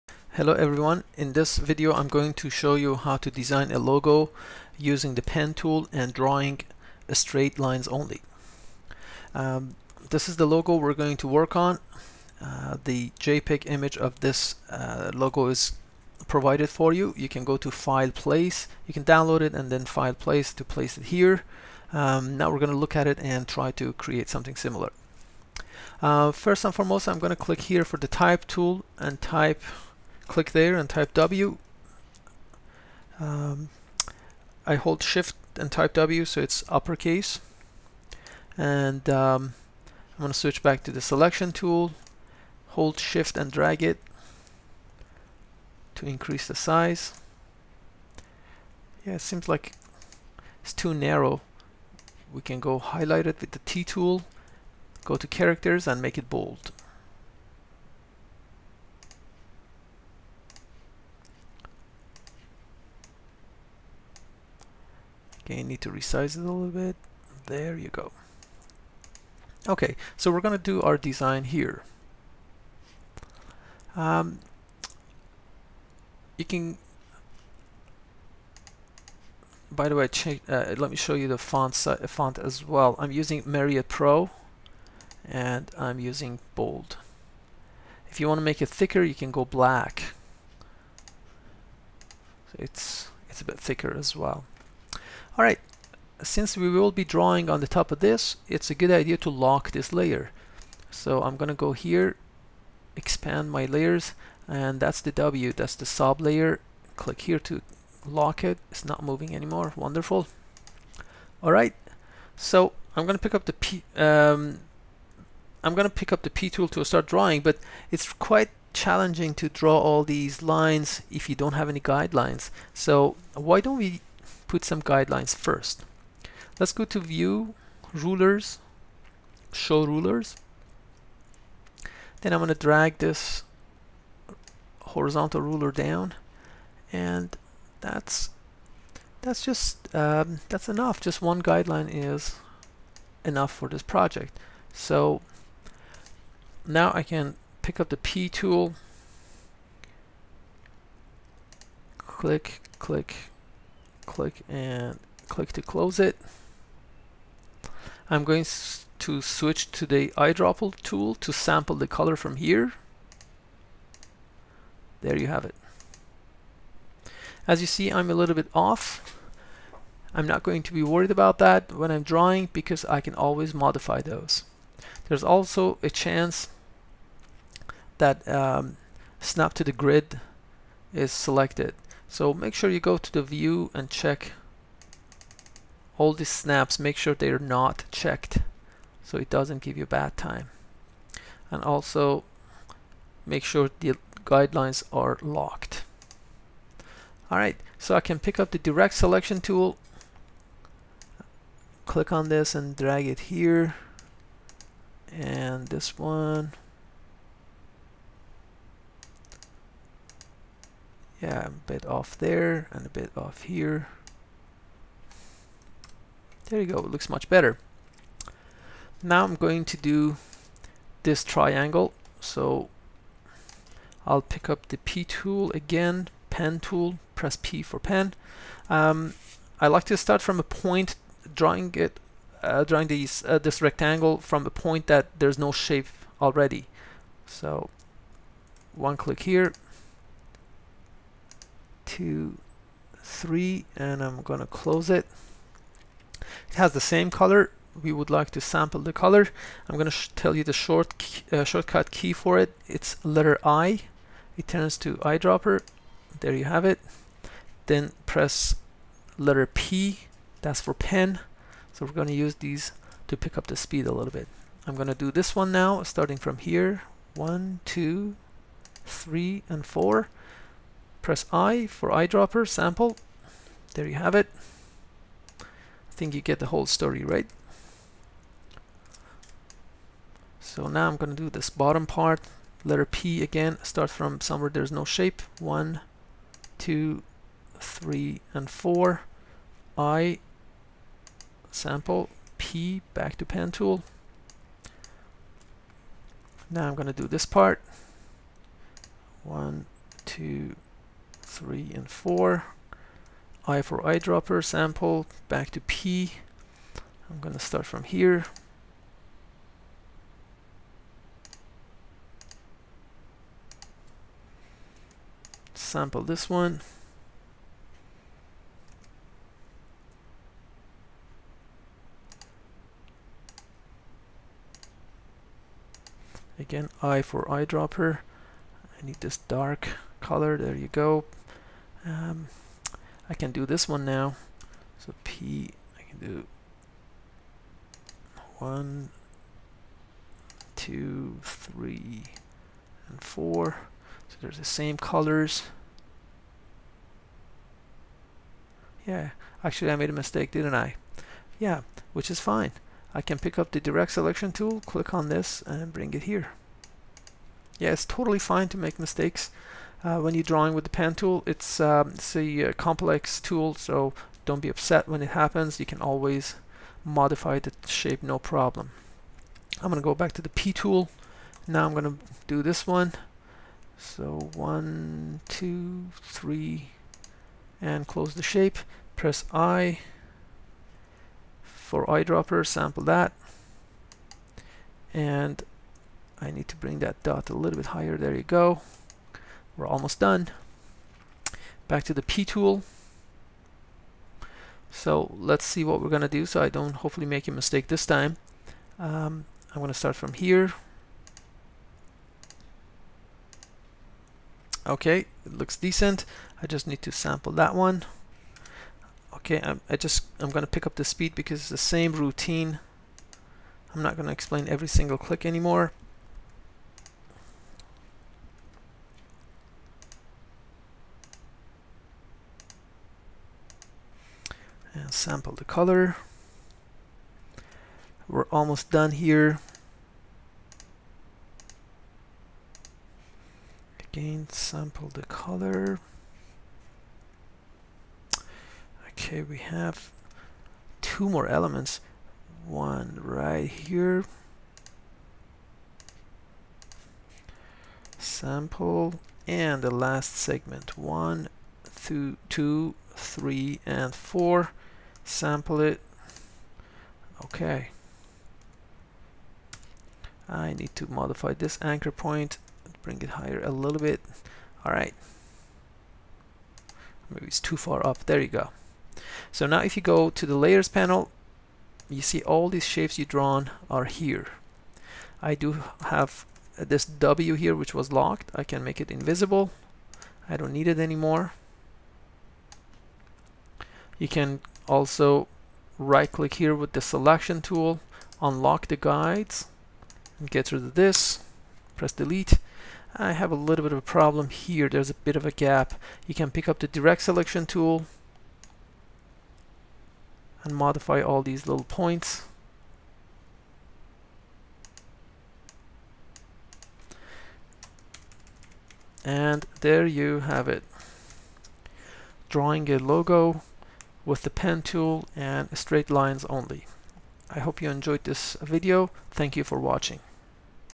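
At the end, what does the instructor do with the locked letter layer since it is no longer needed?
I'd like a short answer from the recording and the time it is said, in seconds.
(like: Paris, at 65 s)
Make it invisible, at 478 s.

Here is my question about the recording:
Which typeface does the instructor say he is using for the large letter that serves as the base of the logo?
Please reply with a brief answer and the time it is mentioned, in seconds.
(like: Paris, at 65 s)
Myriad Pro, at 83 s.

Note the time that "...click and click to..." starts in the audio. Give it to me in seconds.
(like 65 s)
154 s.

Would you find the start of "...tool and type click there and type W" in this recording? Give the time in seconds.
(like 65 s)
28 s.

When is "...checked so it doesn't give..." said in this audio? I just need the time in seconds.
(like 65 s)
187 s.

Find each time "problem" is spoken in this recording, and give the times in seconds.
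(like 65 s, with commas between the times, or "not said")
368 s, 493 s.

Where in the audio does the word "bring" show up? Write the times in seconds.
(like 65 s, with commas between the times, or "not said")
355 s, 386 s, 462 s.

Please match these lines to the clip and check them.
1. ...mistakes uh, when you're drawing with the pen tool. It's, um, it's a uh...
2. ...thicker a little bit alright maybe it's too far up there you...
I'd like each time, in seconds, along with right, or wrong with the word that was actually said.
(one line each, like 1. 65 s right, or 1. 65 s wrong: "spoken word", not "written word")
1. 358 s right
2. 463 s wrong: "higher", not "thicker".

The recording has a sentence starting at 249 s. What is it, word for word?
I'm gonna tell you the short uh, shortcut key for it.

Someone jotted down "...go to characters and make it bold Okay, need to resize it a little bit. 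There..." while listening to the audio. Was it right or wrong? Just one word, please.
right.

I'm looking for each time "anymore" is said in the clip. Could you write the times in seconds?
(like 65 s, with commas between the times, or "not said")
109 s, 415 s, 480 s.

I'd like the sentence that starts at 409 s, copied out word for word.
Okay, I'm, I just I'm going to pick up the speed because it's the same routine.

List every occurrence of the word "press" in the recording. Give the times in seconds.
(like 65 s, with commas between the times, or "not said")
227 s, 258 s, 271 s, 378 s, 491 s.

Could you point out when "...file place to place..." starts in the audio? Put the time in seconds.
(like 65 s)
19 s.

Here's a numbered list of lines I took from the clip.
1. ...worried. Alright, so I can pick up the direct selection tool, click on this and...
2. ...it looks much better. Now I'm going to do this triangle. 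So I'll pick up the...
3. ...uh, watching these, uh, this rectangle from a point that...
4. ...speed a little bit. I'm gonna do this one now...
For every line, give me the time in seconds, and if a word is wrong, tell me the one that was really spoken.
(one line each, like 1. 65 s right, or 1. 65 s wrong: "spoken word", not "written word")
1. 195 s wrong: "locked", not "worried"
2. 216 s right
3. 232 s wrong: "drawing", not "watching"
4. 263 s right.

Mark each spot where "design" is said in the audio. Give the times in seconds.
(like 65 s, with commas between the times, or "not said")
3 s, 70 s.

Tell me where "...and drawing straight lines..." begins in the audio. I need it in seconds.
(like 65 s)
5 s.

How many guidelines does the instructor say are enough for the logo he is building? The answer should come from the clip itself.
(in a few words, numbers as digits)
1.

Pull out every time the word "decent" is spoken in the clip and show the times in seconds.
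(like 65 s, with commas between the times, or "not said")
405 s.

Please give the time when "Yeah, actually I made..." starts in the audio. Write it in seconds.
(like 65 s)
348 s.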